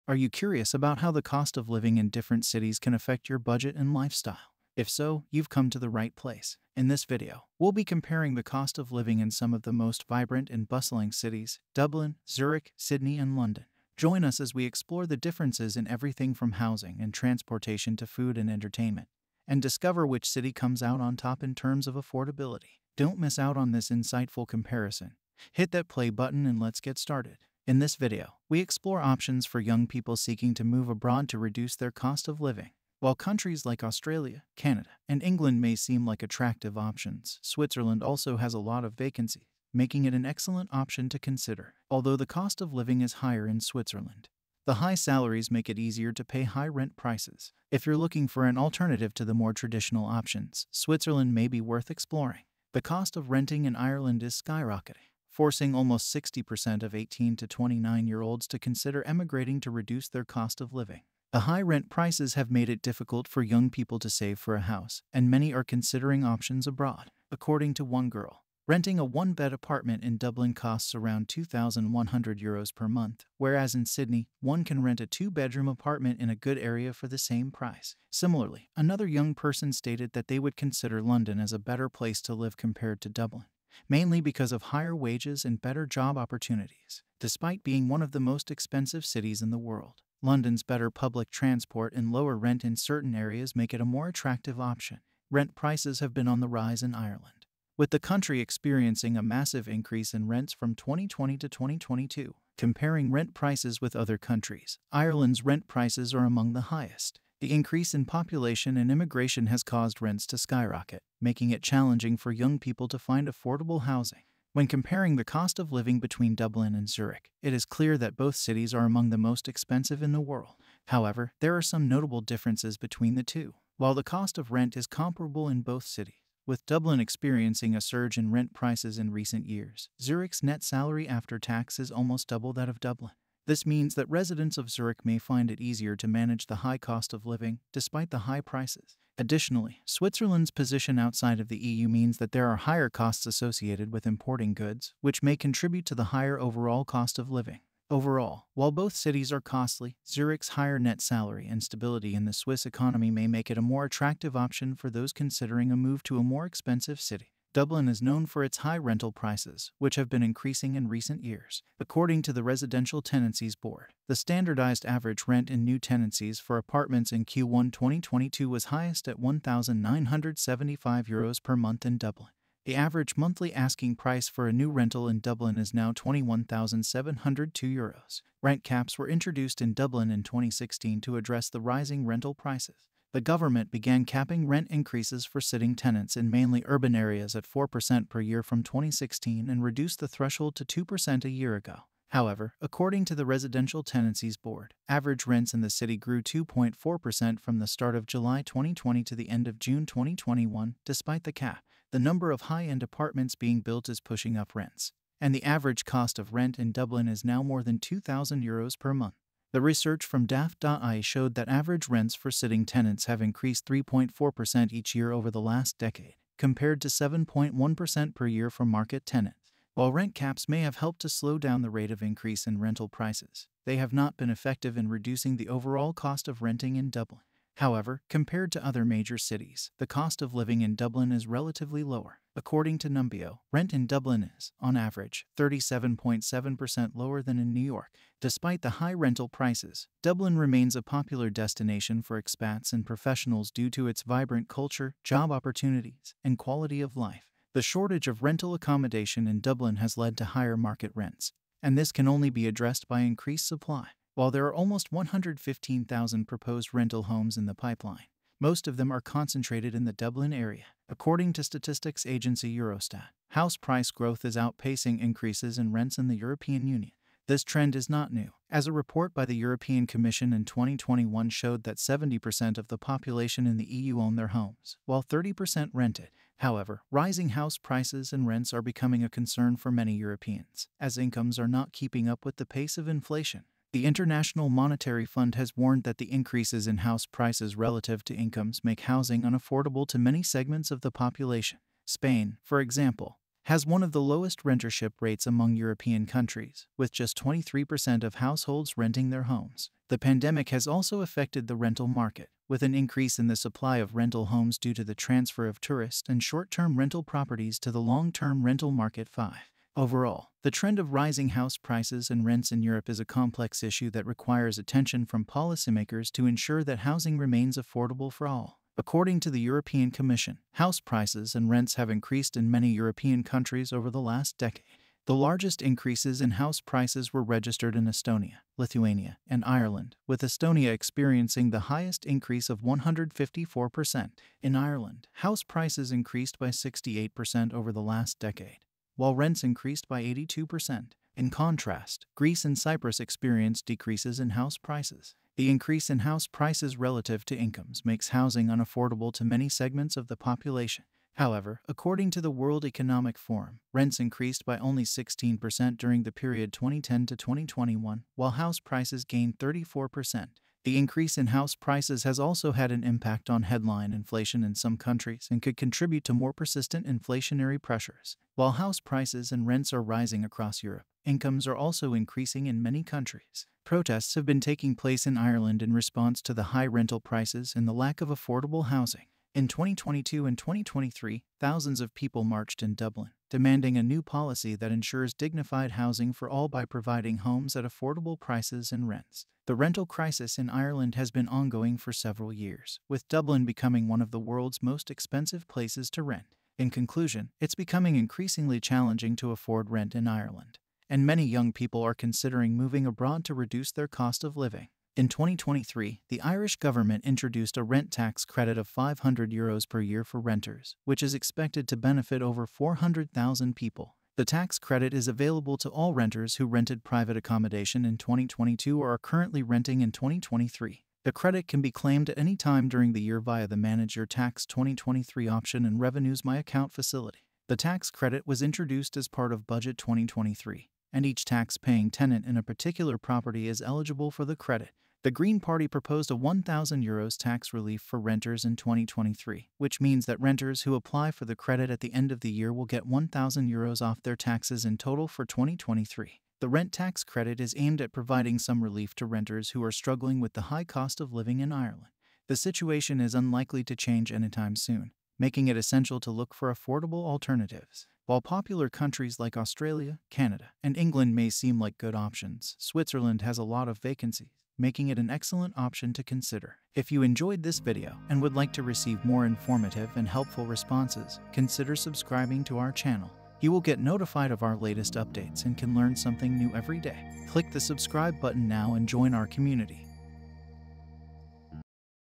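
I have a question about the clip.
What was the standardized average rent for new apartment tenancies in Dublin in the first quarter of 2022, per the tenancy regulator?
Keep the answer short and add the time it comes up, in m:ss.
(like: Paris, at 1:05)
1,975 euros, at 2:49.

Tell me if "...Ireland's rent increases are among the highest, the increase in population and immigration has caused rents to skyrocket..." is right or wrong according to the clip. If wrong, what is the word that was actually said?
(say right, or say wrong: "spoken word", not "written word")
wrong: "prices", not "increases".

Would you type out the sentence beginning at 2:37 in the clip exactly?
Dublin is known for its high rental prices, which have been increasing in recent years.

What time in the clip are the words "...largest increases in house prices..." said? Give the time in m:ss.
5:25.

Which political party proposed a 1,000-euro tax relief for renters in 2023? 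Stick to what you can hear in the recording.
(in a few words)
The Green Party.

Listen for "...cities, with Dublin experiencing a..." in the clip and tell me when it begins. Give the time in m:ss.
2:05.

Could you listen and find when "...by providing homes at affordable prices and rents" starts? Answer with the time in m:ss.
6:26.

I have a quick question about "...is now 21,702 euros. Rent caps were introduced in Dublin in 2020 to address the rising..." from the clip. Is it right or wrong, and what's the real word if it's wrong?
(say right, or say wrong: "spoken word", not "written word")
wrong: "2016", not "2020".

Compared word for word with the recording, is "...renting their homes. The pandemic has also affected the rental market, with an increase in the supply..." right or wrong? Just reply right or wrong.
right.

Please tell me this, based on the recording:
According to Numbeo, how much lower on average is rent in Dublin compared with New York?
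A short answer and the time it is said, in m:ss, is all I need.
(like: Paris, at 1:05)
37.7%, at 3:55.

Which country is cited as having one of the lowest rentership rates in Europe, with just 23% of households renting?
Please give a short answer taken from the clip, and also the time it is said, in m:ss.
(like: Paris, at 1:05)
Spain, at 4:51.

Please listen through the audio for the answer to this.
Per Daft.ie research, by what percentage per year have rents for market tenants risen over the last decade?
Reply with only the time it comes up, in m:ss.
3:36.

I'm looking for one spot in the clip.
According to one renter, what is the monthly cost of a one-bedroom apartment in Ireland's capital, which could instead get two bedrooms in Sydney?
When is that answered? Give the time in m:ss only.
1:11.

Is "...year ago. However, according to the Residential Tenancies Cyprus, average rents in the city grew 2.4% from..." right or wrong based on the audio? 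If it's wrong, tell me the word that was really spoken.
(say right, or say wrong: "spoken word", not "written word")
wrong: "Board", not "Cyprus".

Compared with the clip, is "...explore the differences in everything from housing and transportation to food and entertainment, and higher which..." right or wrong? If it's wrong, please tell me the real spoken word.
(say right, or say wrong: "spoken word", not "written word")
wrong: "discover", not "higher".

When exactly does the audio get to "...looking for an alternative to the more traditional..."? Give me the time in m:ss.
0:47.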